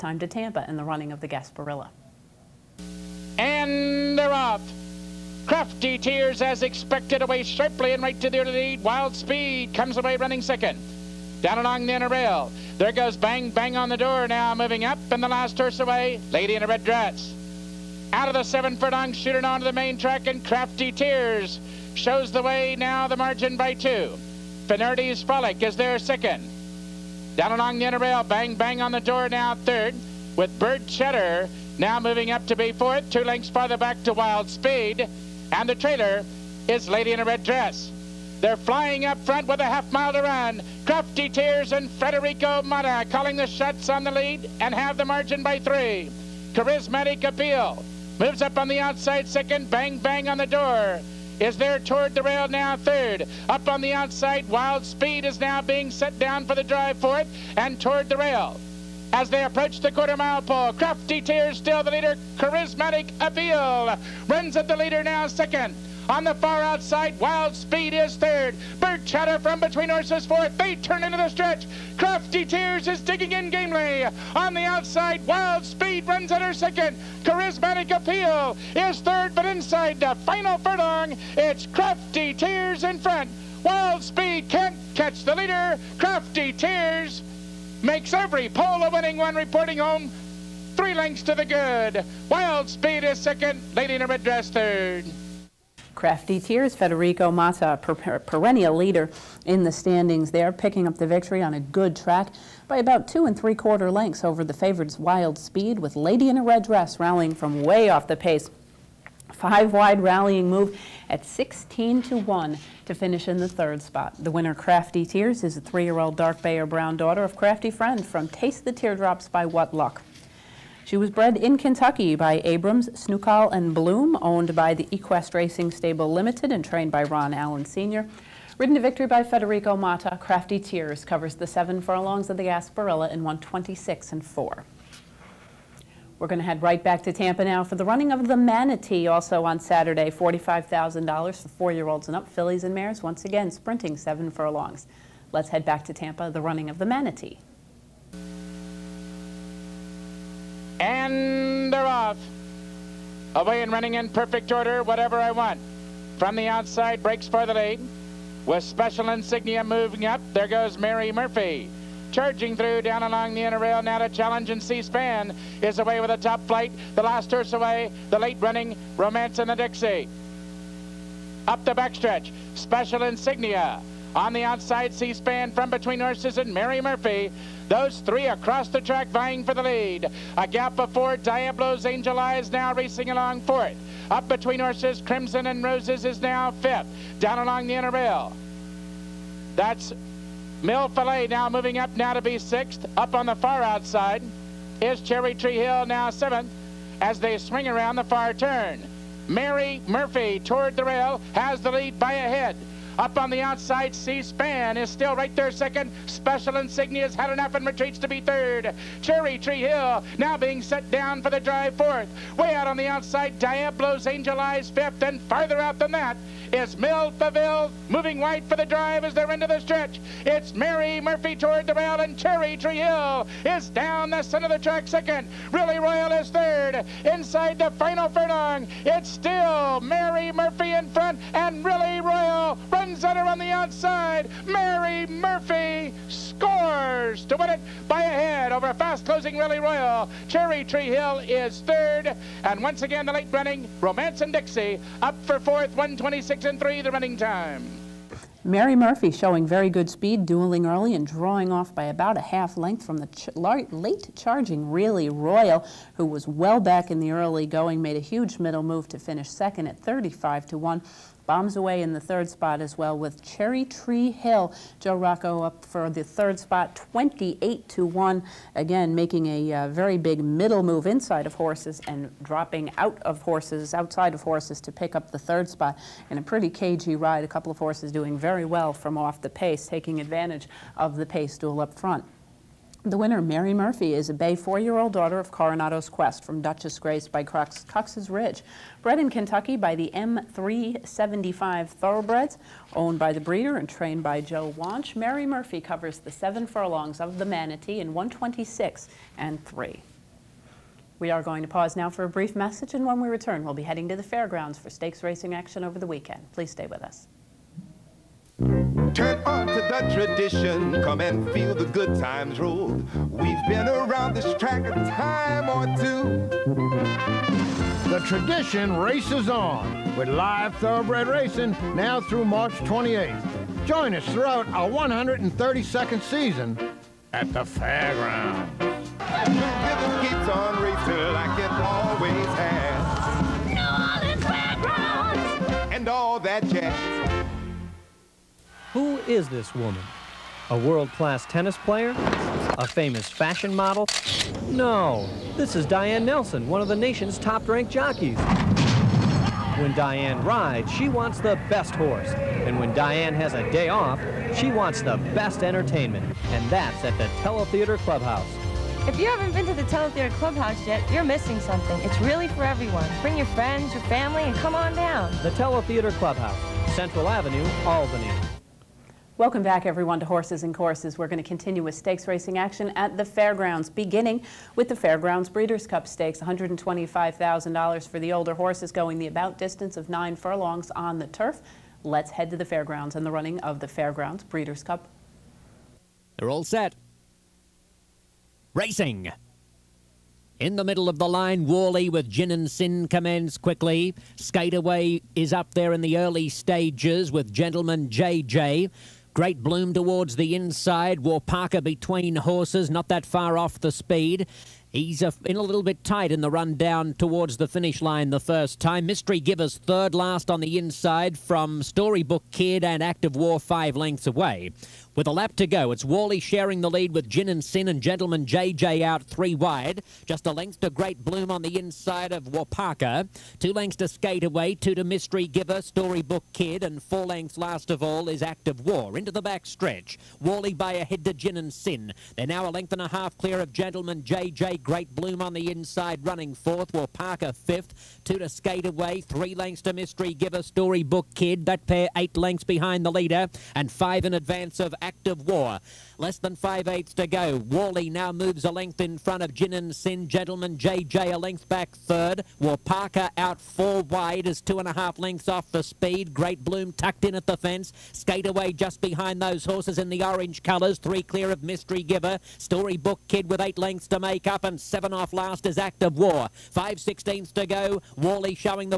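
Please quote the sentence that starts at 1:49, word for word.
Five wide rallying move at 16 to 1 to finish in the third spot.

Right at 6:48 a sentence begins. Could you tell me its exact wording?
Mystery Givers third last on the inside from Storybook Kid and Active War five lengths away.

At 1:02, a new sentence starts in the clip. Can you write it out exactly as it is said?
Charismatic Appeal runs at the leader now second.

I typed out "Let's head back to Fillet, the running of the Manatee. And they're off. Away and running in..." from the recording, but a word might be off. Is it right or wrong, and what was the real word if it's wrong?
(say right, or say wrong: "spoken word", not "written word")
wrong: "Tampa", not "Fillet".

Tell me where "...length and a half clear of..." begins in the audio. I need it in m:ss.
7:12.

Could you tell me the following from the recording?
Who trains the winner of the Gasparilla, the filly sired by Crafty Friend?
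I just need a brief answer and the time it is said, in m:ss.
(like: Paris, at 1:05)
Ron Allen Sr., at 2:07.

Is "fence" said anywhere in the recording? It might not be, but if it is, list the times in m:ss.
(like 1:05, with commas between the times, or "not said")
7:37.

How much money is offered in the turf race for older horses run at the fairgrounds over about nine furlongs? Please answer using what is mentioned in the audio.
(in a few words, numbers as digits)
$125,000.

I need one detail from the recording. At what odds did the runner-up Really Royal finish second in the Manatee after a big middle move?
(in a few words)
35 to 1.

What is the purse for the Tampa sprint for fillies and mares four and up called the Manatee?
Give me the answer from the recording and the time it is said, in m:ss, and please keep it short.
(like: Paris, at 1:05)
$45,000, at 2:20.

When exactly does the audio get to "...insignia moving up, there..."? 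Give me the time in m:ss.
2:39.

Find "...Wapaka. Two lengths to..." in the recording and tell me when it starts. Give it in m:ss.
7:02.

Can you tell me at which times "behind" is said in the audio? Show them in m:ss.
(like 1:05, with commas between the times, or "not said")
7:22, 7:38.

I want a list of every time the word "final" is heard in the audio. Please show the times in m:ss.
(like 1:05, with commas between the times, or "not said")
1:20, 3:47.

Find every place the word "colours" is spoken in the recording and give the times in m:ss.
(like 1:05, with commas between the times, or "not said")
7:40.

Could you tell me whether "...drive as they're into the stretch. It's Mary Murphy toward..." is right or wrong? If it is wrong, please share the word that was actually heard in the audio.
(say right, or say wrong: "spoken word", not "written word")
right.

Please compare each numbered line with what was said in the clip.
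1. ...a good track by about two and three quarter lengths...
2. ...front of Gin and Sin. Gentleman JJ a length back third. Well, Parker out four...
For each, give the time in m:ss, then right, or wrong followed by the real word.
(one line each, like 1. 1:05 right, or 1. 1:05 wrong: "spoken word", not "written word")
1. 1:41 right
2. 7:28 right.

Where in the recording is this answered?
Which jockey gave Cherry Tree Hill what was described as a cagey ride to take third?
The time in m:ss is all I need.
4:24.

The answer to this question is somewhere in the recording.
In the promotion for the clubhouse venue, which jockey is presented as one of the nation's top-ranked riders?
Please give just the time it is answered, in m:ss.
5:45.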